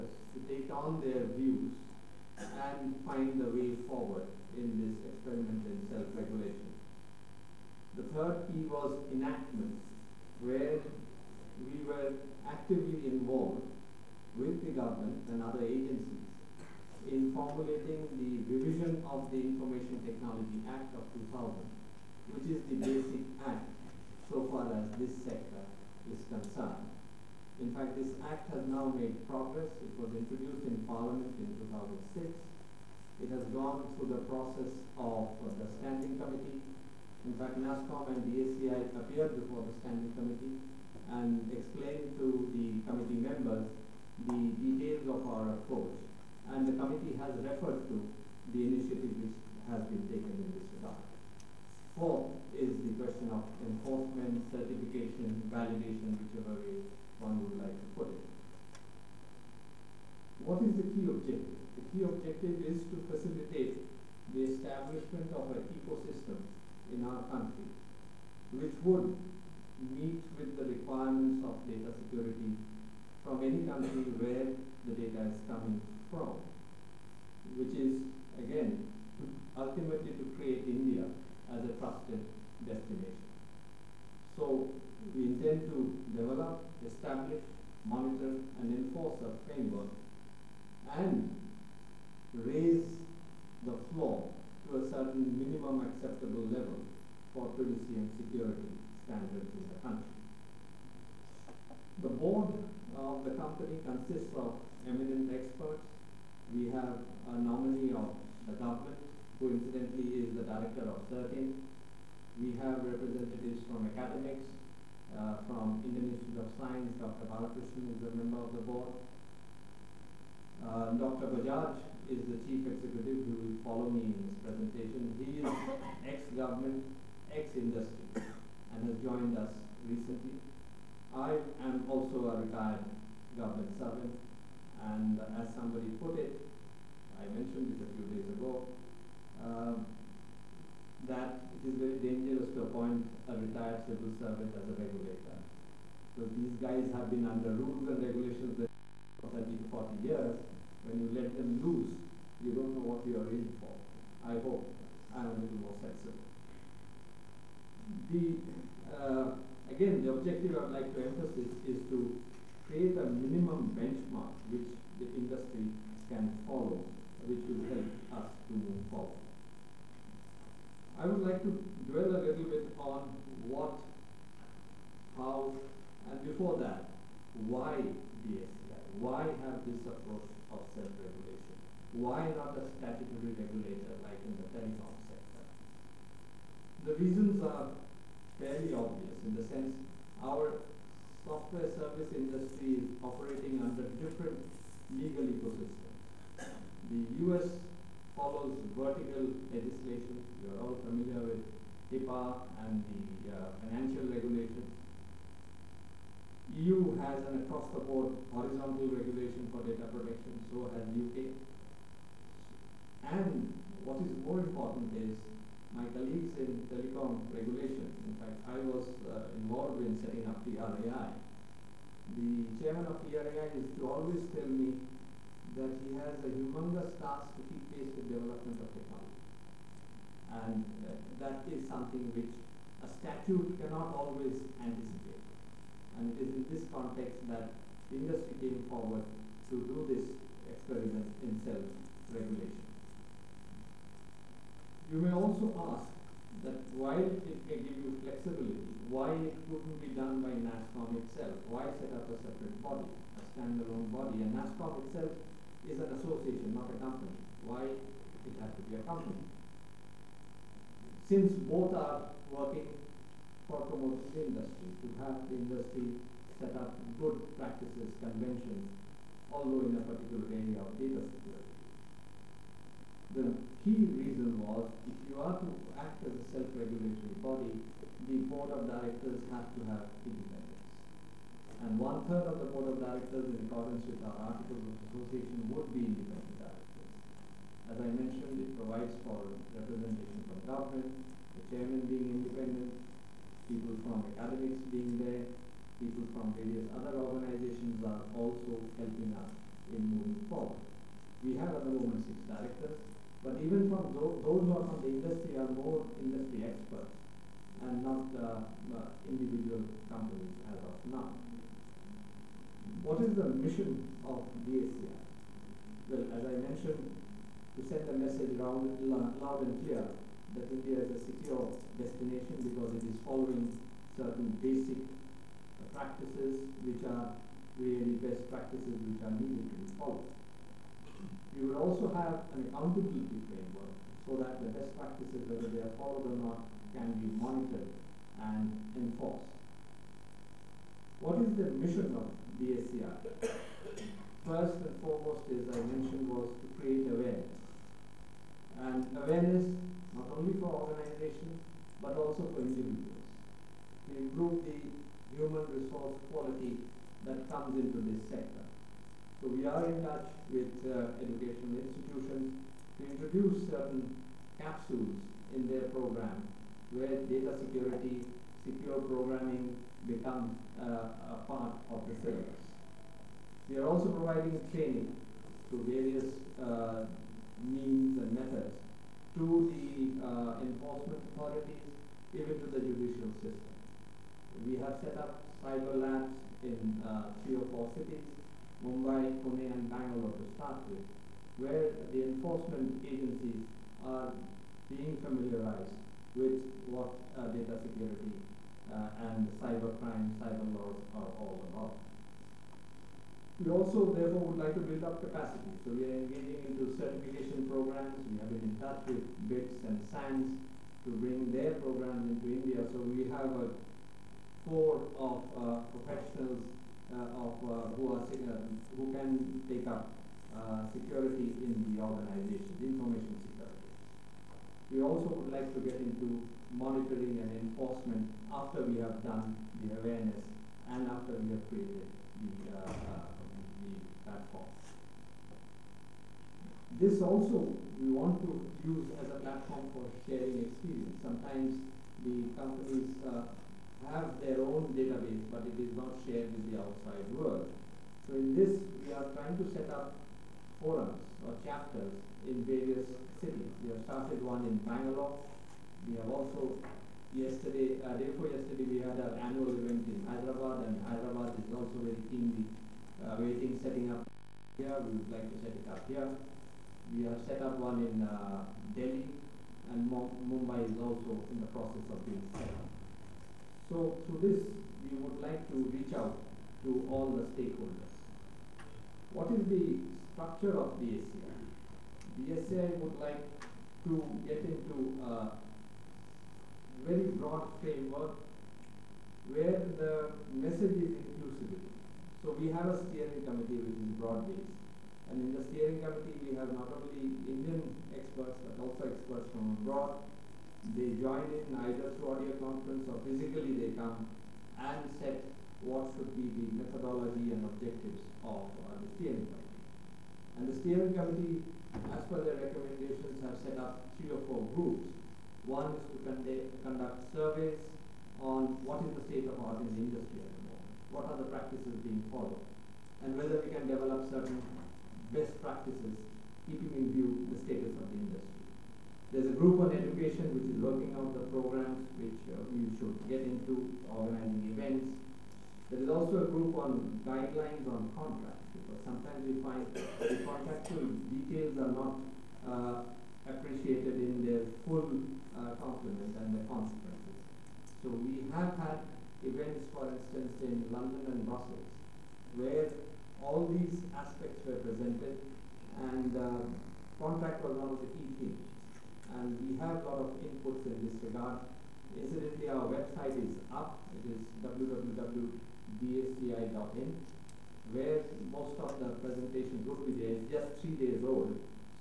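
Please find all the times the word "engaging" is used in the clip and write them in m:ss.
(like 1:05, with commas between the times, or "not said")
6:46.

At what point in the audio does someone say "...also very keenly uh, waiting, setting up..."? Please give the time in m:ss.
7:41.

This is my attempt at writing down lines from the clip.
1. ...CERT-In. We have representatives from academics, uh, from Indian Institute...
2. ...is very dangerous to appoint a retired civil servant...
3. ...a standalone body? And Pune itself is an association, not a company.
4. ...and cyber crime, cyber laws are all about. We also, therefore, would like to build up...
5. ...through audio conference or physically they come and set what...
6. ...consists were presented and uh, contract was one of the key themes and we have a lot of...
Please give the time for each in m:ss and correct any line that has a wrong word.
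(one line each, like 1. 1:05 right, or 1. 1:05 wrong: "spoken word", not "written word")
1. 1:51 right
2. 2:21 right
3. 4:13 wrong: "NASSCOM", not "Pune"
4. 6:39 right
5. 8:21 right
6. 9:13 wrong: "aspects", not "consists".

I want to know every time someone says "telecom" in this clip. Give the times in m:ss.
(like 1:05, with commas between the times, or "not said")
3:04, 3:36.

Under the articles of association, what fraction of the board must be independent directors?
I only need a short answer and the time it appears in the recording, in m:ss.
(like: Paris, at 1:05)
One third, at 4:41.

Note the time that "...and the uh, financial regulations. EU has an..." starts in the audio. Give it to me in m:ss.
3:22.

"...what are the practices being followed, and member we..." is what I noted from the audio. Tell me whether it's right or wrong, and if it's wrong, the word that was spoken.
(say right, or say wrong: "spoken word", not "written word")
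wrong: "whether", not "member".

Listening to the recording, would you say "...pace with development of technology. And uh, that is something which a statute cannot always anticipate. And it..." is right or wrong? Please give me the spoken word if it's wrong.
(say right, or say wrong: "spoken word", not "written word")
right.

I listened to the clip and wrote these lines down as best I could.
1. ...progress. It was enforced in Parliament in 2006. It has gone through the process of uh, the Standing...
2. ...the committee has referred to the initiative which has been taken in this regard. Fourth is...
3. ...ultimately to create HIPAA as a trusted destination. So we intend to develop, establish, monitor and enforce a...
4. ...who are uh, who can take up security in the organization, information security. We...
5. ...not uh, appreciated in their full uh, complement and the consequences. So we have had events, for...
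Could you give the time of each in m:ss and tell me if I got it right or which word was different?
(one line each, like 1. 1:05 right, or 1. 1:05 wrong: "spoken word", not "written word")
1. 0:29 wrong: "introduced", not "enforced"
2. 0:46 right
3. 1:19 wrong: "India", not "HIPAA"
4. 6:57 right
5. 9:01 right.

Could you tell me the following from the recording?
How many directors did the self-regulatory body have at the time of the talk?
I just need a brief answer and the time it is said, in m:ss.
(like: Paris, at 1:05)
6, at 5:02.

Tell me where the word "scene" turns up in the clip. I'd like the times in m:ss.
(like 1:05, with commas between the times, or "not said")
not said.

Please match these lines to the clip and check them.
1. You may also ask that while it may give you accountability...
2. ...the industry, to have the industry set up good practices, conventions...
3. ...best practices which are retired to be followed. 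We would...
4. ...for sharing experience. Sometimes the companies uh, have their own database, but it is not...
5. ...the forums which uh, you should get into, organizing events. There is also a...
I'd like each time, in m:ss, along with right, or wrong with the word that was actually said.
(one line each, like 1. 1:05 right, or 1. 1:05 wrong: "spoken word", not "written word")
1. 4:04 wrong: "flexibility", not "accountability"
2. 4:24 right
3. 5:28 wrong: "needed", not "retired"
4. 7:19 right
5. 8:51 wrong: "programs", not "forums".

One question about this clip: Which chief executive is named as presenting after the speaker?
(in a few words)
Dr. Bajaj.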